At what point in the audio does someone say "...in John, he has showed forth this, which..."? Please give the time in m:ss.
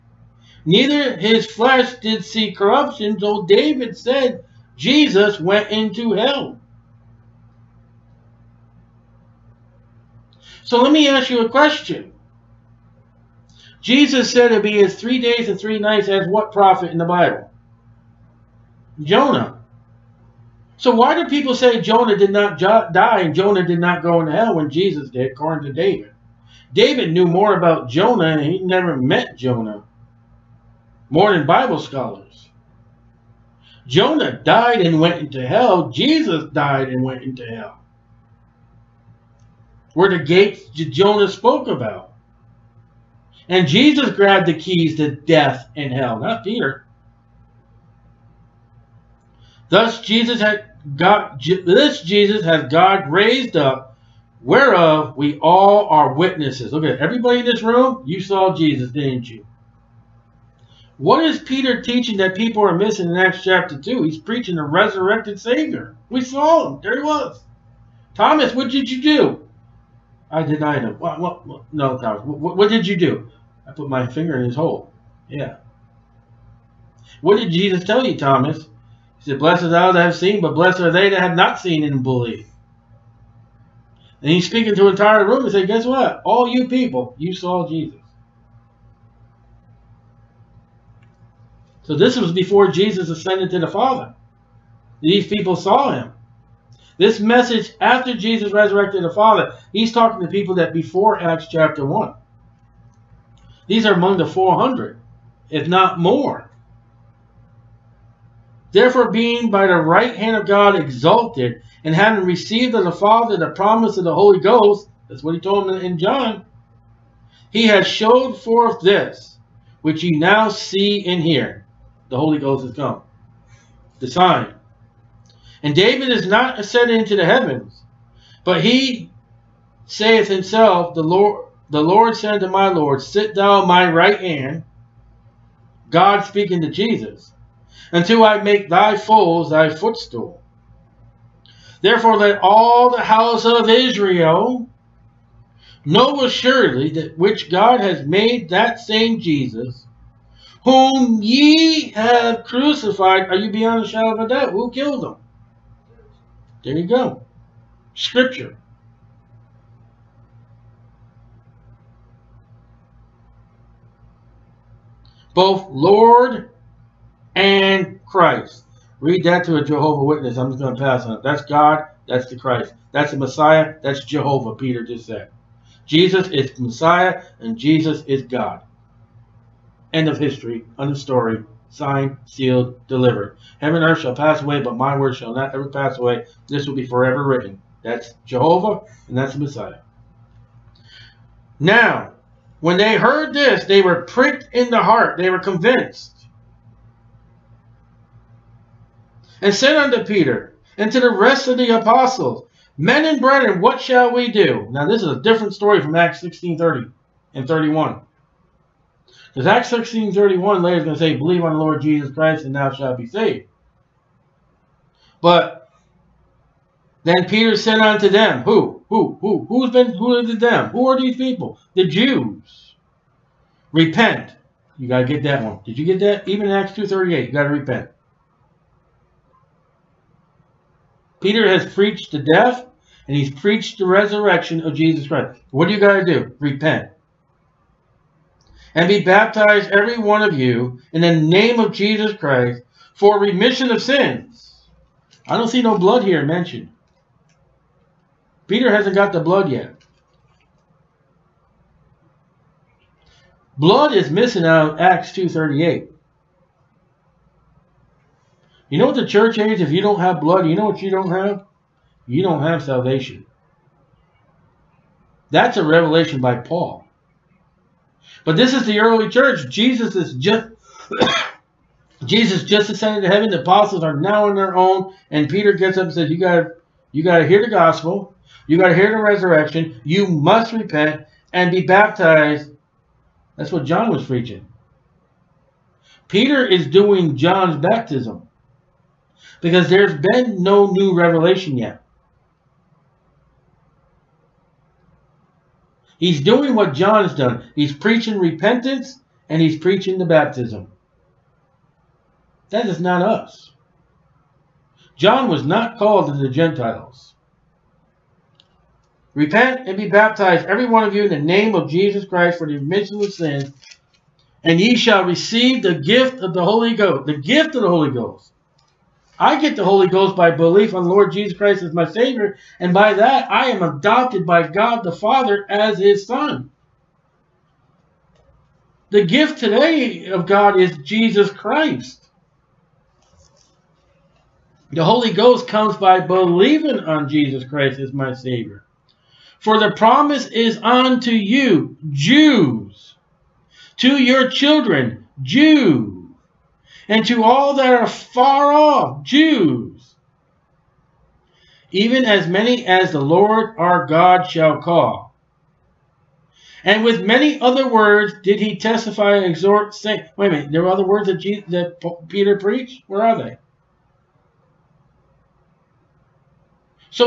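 1:55.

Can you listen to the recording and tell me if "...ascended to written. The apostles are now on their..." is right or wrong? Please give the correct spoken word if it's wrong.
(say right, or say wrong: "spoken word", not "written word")
wrong: "heaven", not "written".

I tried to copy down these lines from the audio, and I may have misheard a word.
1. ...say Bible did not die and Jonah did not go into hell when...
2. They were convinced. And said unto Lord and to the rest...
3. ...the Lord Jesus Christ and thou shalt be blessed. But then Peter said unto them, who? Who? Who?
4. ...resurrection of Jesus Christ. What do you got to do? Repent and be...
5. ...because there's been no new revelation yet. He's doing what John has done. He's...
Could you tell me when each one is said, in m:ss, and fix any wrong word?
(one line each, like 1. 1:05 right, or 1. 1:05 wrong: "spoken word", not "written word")
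1. 0:21 wrong: "Jonah", not "Bible"
2. 3:15 wrong: "Peter", not "Lord"
3. 3:31 wrong: "saved", not "blessed"
4. 3:53 right
5. 4:49 right.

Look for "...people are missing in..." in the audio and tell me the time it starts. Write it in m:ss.
1:02.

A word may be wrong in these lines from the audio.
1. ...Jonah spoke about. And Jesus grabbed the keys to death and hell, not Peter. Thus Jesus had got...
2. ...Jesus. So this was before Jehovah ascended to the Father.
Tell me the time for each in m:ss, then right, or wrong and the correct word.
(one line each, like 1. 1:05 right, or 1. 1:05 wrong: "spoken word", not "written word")
1. 0:40 right
2. 1:27 wrong: "Jesus", not "Jehovah".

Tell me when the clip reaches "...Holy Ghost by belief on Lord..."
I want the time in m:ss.
5:19.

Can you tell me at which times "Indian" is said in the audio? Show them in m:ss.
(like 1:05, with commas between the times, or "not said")
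not said.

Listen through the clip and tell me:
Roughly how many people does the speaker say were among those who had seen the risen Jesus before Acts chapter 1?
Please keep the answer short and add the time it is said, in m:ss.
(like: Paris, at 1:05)
400, at 1:44.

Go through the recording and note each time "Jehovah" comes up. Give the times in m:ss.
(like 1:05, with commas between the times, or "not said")
2:49, 2:54, 3:08.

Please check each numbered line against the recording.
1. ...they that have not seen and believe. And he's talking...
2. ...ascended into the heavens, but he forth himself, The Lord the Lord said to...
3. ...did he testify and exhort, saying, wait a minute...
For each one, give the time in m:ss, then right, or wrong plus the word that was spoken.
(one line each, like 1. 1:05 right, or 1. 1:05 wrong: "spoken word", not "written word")
1. 1:20 wrong: "speaking", not "talking"
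2. 2:06 wrong: "saith", not "forth"
3. 5:58 right.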